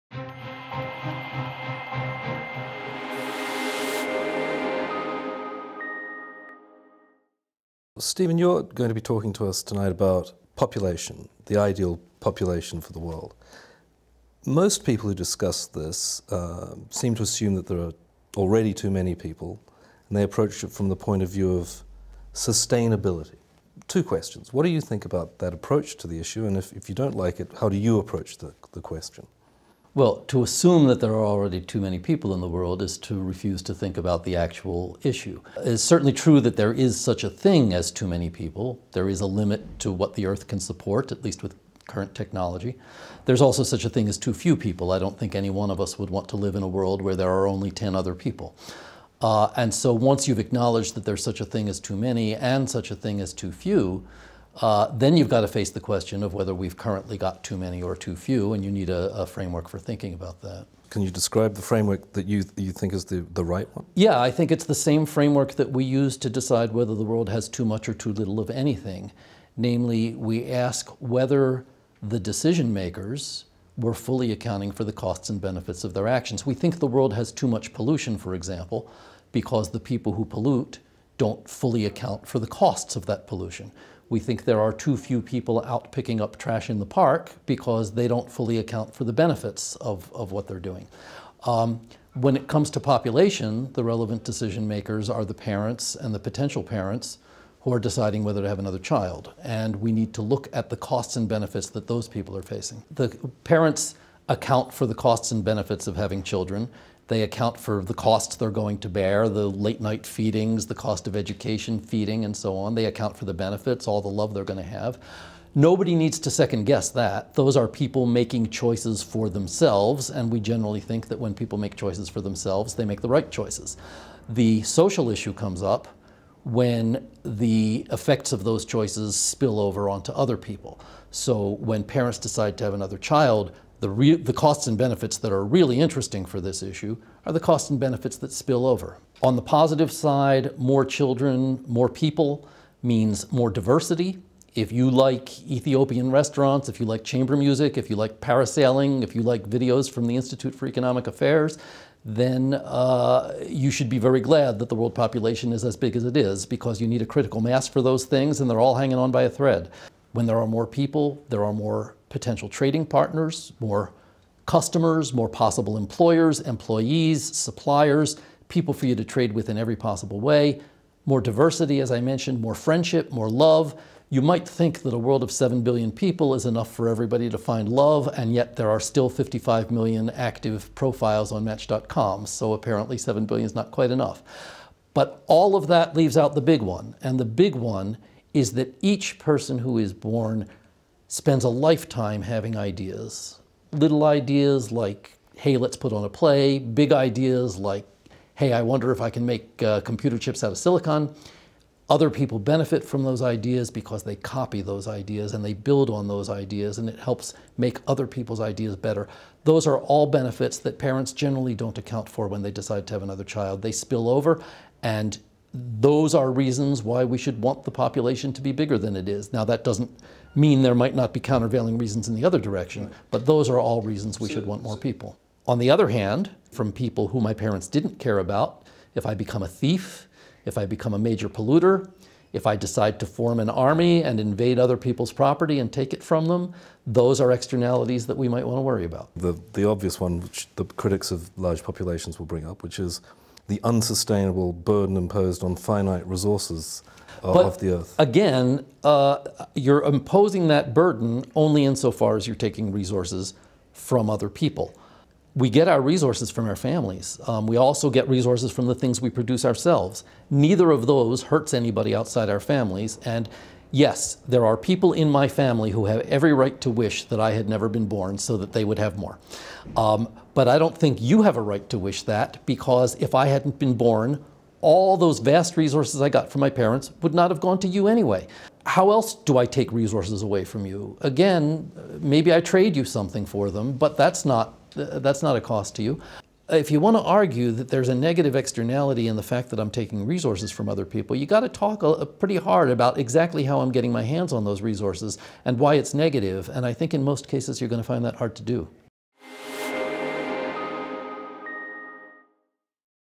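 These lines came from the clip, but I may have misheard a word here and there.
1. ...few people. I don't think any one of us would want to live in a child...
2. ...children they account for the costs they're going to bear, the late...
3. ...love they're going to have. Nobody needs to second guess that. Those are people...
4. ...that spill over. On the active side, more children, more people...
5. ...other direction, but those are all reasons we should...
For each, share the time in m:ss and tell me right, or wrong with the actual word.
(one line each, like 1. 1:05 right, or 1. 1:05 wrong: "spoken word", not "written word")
1. 0:44 wrong: "world", not "child"
2. 1:46 right
3. 1:54 right
4. 2:18 wrong: "positive", not "active"
5. 3:42 right.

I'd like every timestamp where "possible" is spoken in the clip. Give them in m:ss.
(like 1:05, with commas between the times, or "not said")
2:45, 2:49.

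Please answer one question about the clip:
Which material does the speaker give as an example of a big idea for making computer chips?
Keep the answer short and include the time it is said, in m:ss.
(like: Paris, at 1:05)
silicon, at 3:20.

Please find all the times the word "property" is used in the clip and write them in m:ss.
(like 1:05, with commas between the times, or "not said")
3:55.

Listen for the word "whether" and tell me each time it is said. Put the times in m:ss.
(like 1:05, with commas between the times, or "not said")
0:56, 1:06, 1:11, 1:38.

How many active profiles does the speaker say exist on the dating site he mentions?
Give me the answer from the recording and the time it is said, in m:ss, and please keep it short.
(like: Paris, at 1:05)
55 million, at 2:59.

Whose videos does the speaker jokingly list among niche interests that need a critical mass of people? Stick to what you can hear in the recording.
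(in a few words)
Institute for Economic Affairs.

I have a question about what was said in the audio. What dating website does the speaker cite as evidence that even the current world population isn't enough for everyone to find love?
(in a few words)
Match.com.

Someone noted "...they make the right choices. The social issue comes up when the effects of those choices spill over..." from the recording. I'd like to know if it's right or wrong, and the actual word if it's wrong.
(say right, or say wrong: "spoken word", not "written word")
right.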